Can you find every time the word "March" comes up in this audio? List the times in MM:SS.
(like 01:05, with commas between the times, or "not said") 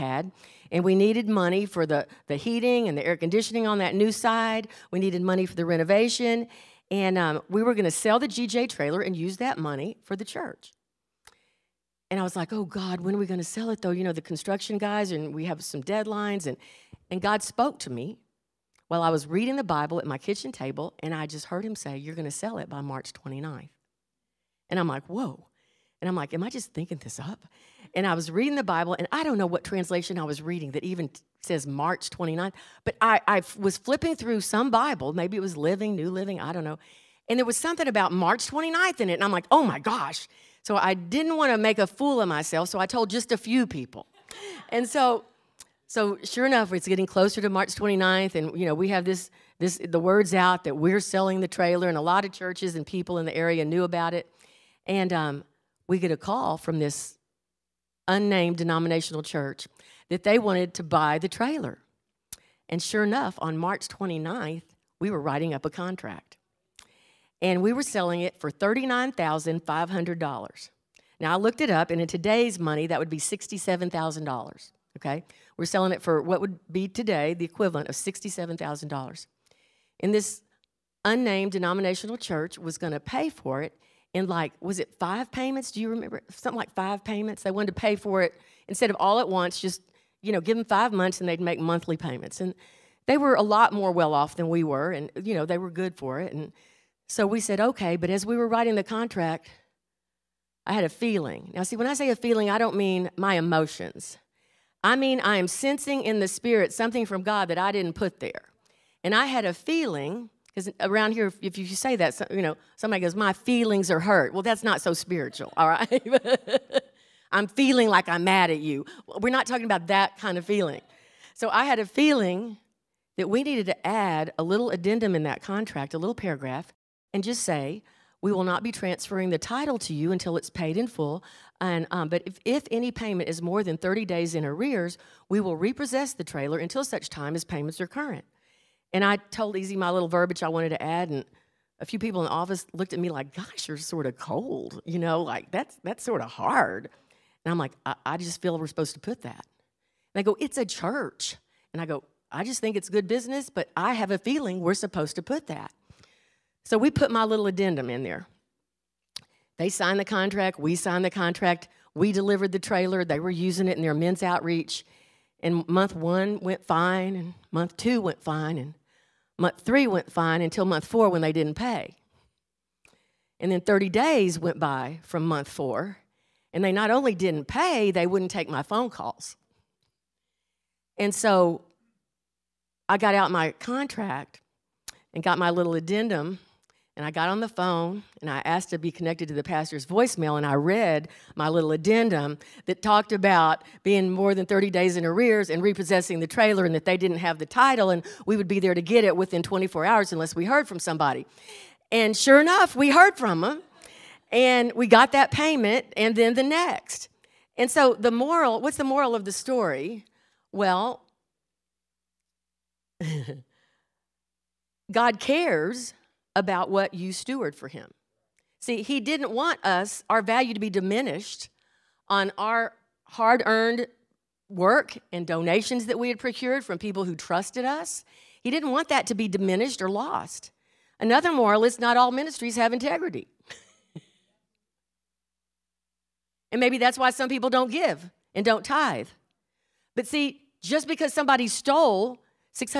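00:22, 00:31, 00:38, 00:47, 01:03.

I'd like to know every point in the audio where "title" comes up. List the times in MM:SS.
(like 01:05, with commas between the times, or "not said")
02:09, 03:17.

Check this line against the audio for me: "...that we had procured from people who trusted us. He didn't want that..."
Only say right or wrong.
right.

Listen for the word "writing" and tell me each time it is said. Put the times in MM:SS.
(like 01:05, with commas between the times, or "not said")
01:05, 01:38.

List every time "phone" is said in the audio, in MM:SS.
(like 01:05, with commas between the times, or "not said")
02:58, 03:07.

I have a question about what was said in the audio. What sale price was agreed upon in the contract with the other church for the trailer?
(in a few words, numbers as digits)
$39,500.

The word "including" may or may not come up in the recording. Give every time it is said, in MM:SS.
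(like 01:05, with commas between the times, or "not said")
not said.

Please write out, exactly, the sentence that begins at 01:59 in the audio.
We're not talking about that kind of feeling.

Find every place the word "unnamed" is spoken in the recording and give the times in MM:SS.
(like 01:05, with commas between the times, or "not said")
00:58, 01:21.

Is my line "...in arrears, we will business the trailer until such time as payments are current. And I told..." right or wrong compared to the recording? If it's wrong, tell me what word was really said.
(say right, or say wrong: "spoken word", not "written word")
wrong: "repossess", not "business".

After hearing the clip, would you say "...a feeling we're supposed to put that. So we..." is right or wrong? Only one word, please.
right.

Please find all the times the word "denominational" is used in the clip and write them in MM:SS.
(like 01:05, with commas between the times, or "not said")
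00:58, 01:21.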